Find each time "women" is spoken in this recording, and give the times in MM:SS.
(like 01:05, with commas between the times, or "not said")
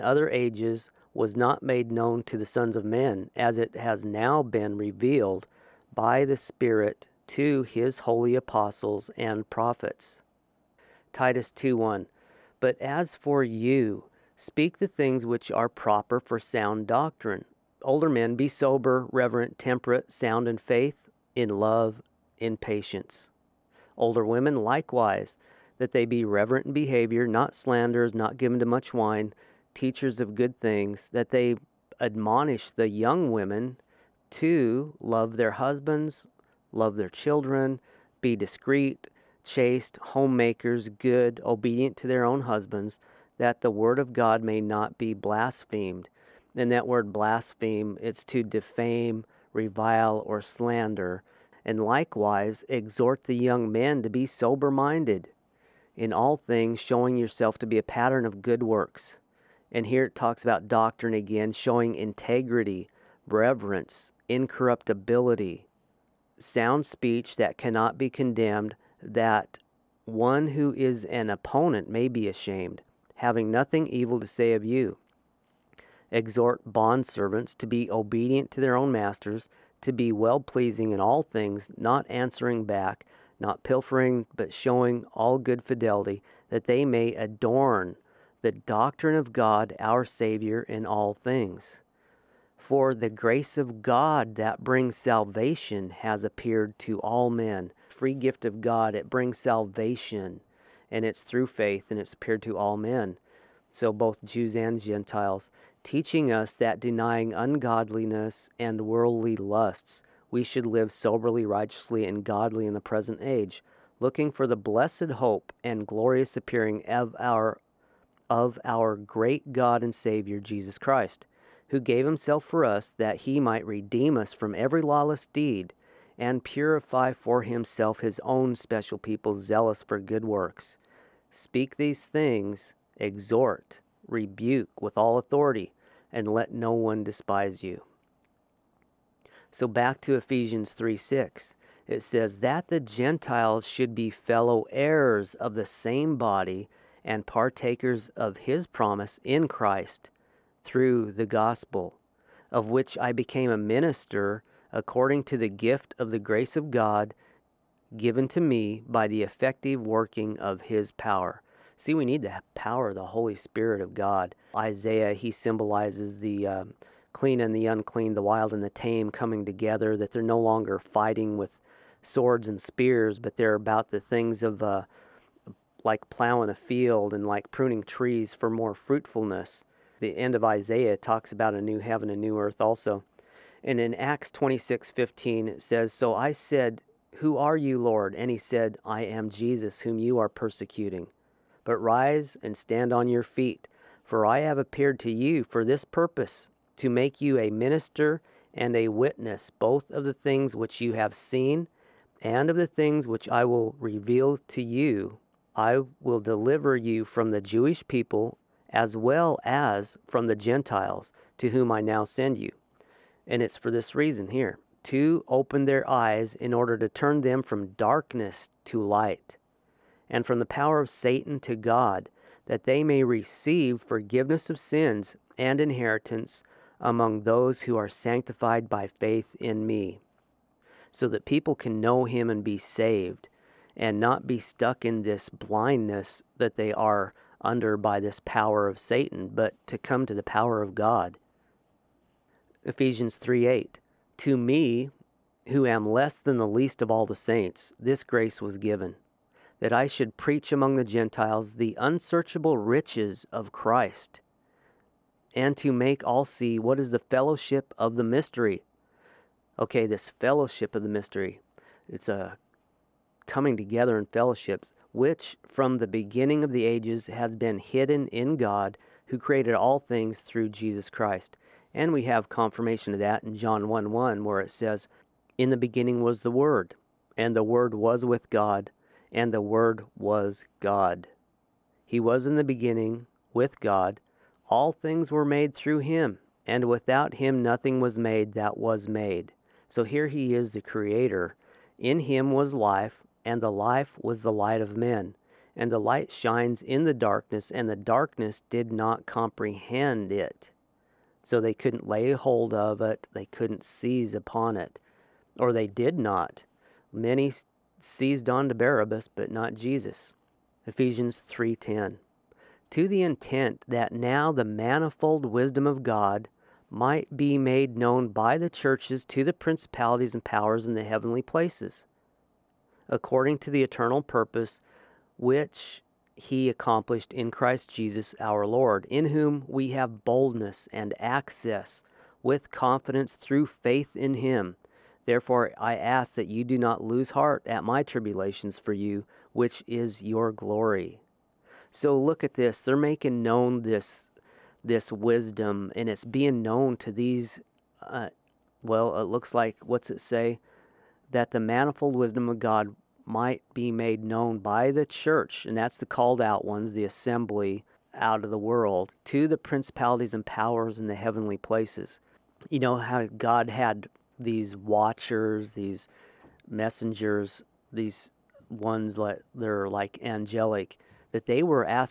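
00:24, 00:33.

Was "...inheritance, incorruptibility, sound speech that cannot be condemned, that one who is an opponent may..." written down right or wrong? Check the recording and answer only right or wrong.
wrong.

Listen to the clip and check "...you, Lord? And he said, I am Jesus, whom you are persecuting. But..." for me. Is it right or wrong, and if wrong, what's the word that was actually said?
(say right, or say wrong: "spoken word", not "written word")
right.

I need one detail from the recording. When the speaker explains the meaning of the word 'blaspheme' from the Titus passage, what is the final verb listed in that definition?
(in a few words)
slander.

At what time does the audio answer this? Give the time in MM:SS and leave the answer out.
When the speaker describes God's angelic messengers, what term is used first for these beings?
06:04.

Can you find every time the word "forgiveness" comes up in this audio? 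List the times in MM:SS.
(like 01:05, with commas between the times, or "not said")
03:43.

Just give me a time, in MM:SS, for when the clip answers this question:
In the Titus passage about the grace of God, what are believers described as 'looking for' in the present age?
01:54.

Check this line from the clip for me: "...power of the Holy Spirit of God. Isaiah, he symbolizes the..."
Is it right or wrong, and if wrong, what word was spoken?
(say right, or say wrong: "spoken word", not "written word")
right.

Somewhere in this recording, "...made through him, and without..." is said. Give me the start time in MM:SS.
04:45.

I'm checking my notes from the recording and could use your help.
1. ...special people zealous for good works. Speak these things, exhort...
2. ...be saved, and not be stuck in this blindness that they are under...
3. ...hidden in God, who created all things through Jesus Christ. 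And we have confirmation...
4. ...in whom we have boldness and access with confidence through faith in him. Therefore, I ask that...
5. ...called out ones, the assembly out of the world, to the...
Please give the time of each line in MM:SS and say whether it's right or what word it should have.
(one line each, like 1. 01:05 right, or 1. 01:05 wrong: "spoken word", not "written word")
1. 02:08 right
2. 03:52 right
3. 04:27 right
4. 05:28 right
5. 05:55 right.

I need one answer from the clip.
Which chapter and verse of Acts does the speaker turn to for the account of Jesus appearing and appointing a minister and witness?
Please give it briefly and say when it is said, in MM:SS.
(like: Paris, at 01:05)
Acts 26:15, at 03:03.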